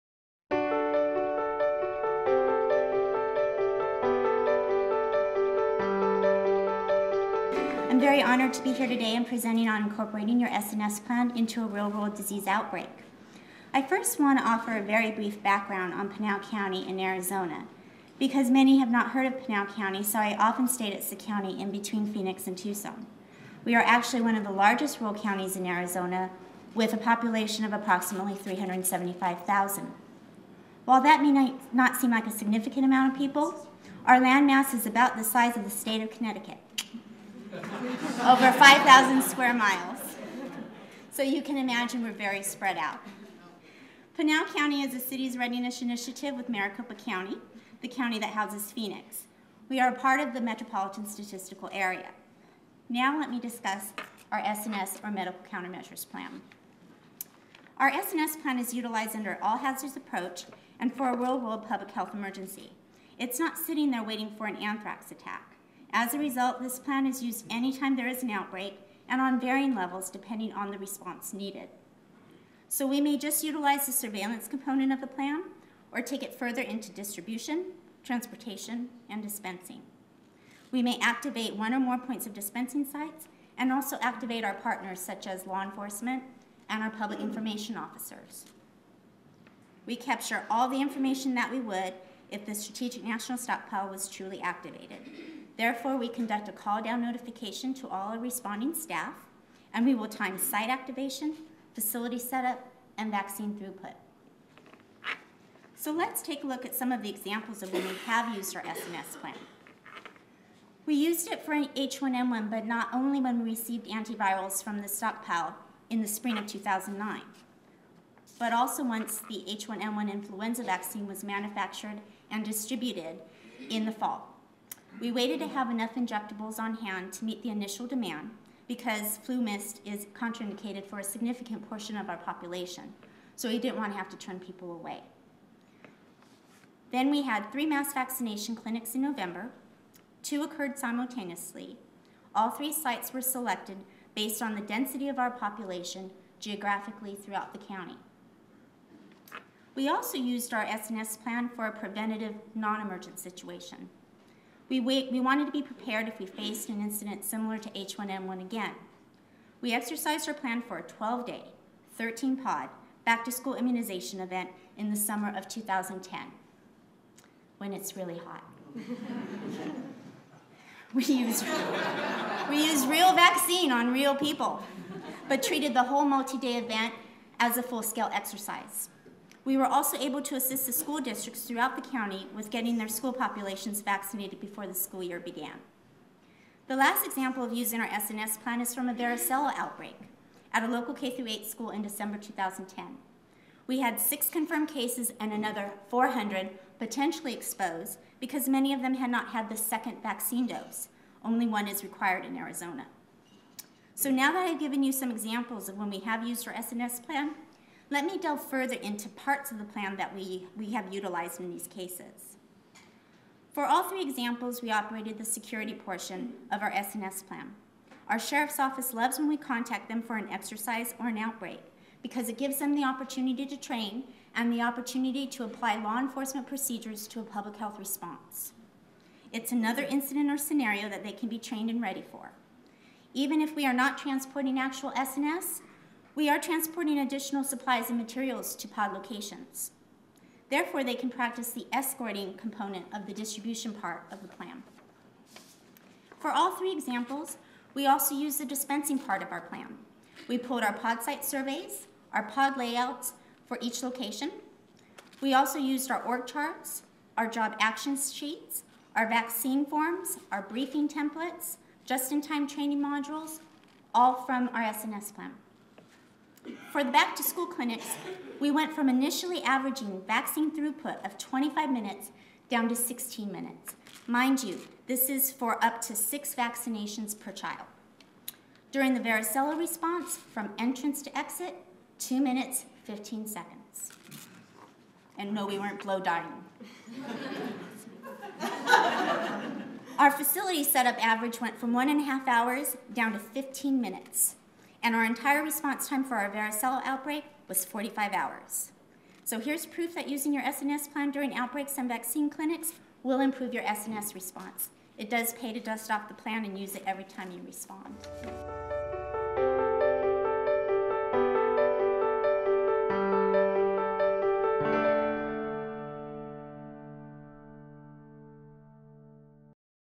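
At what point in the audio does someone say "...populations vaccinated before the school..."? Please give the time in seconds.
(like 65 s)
183 s.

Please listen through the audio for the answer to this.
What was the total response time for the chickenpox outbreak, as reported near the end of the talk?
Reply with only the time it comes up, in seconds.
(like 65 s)
297 s.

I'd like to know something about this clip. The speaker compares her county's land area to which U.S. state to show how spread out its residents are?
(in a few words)
Connecticut.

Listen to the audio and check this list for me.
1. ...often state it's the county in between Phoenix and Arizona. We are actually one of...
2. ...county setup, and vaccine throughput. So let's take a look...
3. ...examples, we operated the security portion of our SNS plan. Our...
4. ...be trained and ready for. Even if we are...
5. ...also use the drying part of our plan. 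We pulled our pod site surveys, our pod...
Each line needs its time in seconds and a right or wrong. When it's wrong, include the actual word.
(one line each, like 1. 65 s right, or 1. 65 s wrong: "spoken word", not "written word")
1. 20 s wrong: "Tucson", not "Arizona"
2. 101 s wrong: "facility", not "county"
3. 214 s right
4. 231 s right
5. 247 s wrong: "dispensing", not "drying".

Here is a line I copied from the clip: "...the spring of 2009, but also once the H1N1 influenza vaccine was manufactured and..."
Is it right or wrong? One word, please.
right.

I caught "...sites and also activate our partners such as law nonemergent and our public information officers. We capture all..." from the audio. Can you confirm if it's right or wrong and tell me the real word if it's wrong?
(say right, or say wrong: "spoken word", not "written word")
wrong: "enforcement", not "nonemergent".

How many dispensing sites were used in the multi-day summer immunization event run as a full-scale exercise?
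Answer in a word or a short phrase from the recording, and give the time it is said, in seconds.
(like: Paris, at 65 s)
13, at 161 s.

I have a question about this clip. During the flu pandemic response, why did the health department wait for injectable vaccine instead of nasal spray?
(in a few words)
FluMist is contraindicated.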